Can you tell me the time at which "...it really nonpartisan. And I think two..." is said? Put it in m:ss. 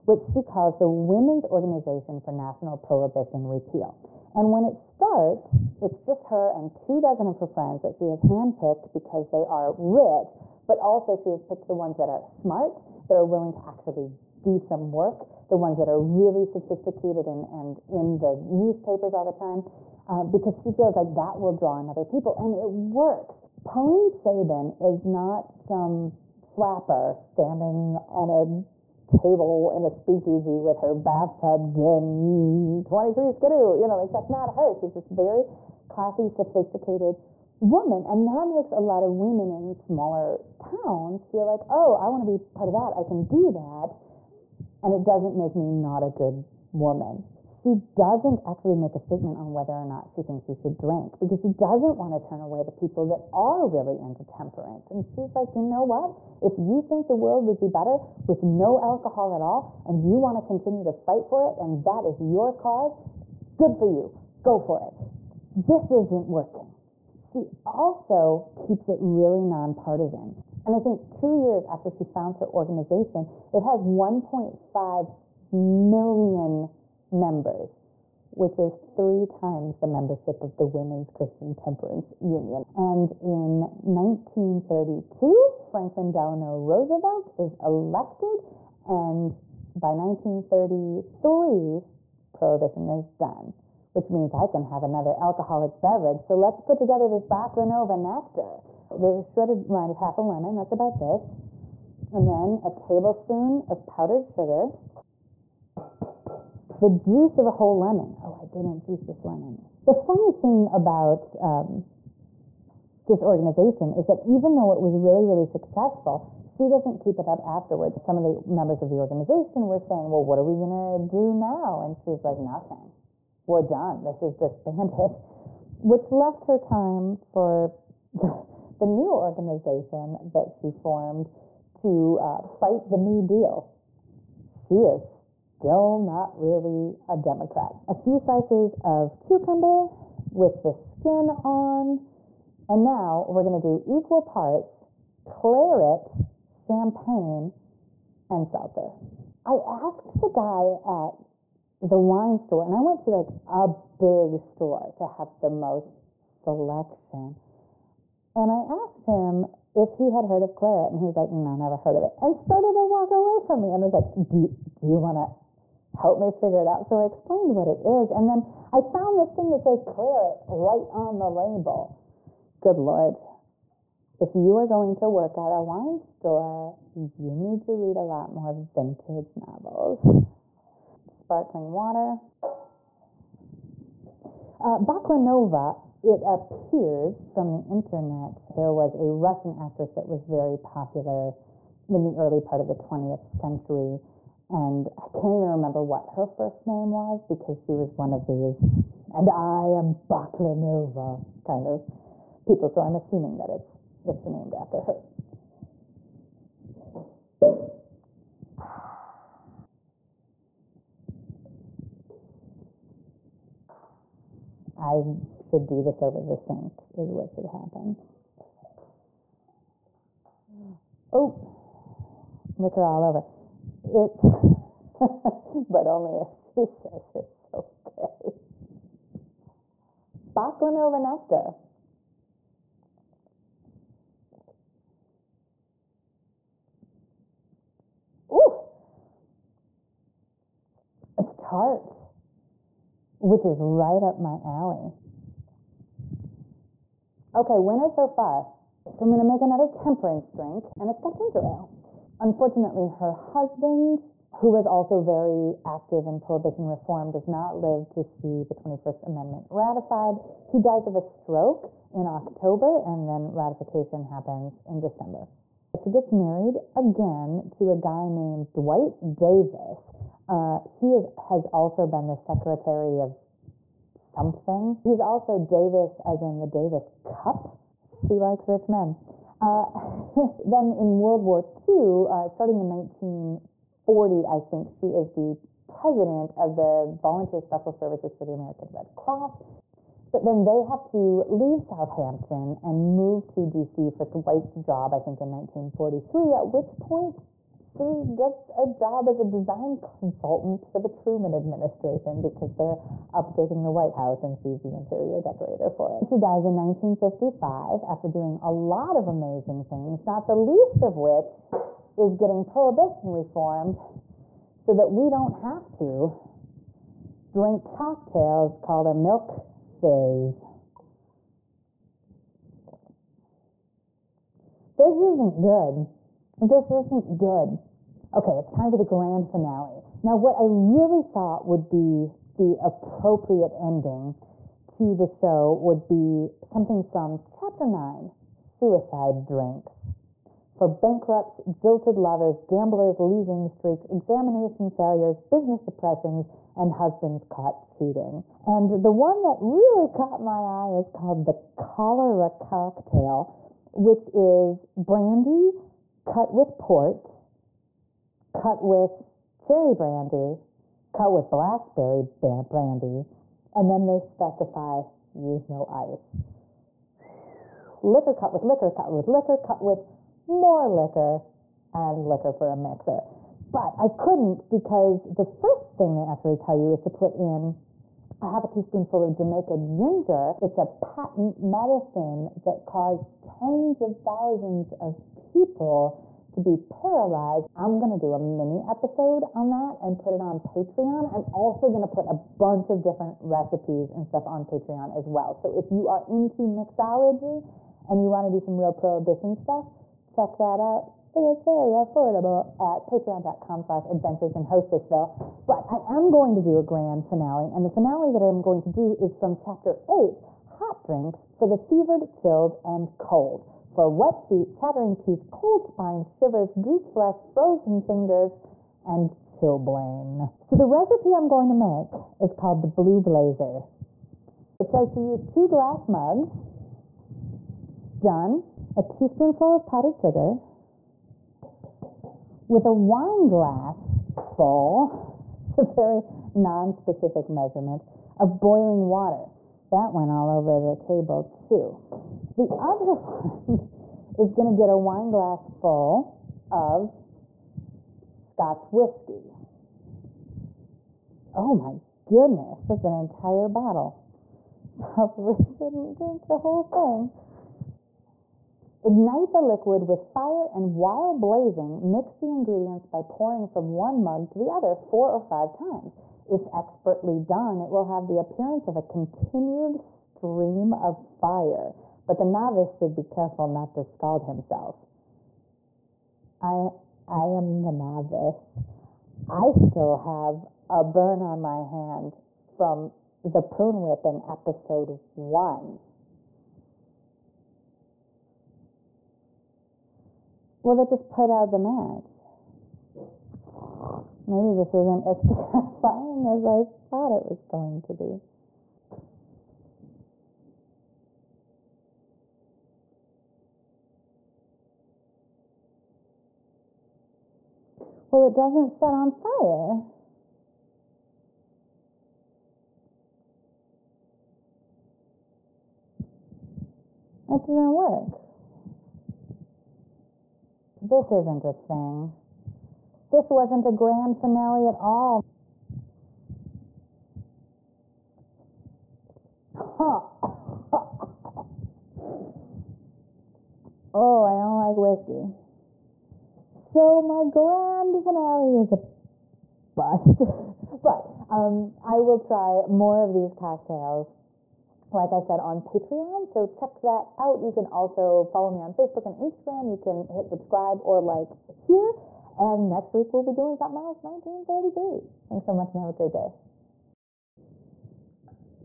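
1:08.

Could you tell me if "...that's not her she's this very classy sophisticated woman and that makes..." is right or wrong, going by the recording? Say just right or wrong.
right.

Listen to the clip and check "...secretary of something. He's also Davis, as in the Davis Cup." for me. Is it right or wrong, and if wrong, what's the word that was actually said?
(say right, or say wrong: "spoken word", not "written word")
right.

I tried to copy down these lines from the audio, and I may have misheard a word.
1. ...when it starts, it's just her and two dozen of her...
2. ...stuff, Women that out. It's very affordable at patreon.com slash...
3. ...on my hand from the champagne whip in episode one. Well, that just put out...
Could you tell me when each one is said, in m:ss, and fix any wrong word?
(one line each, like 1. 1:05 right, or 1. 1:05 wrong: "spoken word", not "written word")
1. 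0:04 right
2. 6:39 wrong: "Check", not "Women"
3. 8:01 wrong: "prune", not "champagne".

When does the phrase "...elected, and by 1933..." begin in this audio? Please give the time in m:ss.
1:27.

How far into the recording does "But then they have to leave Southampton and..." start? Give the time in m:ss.
4:50.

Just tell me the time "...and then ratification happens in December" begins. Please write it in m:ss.
4:22.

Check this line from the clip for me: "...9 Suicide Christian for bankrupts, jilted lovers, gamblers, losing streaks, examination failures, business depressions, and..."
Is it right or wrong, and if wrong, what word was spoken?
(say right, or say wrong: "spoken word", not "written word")
wrong: "Drinks", not "Christian".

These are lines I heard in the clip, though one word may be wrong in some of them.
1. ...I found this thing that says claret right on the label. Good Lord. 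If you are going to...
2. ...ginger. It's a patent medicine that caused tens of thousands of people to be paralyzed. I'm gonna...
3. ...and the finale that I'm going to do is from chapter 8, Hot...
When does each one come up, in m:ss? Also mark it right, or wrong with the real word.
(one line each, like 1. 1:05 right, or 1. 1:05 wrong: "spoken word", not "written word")
1. 2:48 right
2. 6:19 right
3. 6:47 right.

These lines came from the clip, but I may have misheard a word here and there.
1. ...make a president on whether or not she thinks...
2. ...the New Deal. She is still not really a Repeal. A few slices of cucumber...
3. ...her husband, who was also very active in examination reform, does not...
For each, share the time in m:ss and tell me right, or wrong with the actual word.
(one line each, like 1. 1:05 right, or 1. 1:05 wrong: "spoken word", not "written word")
1. 0:48 wrong: "statement", not "president"
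2. 2:12 wrong: "Democrat", not "Repeal"
3. 4:12 wrong: "prohibition", not "examination".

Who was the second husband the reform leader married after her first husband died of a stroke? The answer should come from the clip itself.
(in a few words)
Dwight Davis.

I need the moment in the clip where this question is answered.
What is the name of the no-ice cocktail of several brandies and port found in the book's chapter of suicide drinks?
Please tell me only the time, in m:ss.
5:51.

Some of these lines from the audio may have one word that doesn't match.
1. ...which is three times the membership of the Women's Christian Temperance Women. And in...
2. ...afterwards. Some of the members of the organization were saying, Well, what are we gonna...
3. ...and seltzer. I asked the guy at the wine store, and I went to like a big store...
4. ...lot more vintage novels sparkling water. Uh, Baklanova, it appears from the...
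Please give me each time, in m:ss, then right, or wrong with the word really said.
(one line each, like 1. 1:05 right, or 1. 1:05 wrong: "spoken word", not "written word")
1. 1:18 wrong: "Union", not "Women"
2. 1:57 right
3. 2:28 right
4. 2:58 right.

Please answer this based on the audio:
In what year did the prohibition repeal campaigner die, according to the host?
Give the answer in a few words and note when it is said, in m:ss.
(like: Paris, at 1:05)
1955, at 5:06.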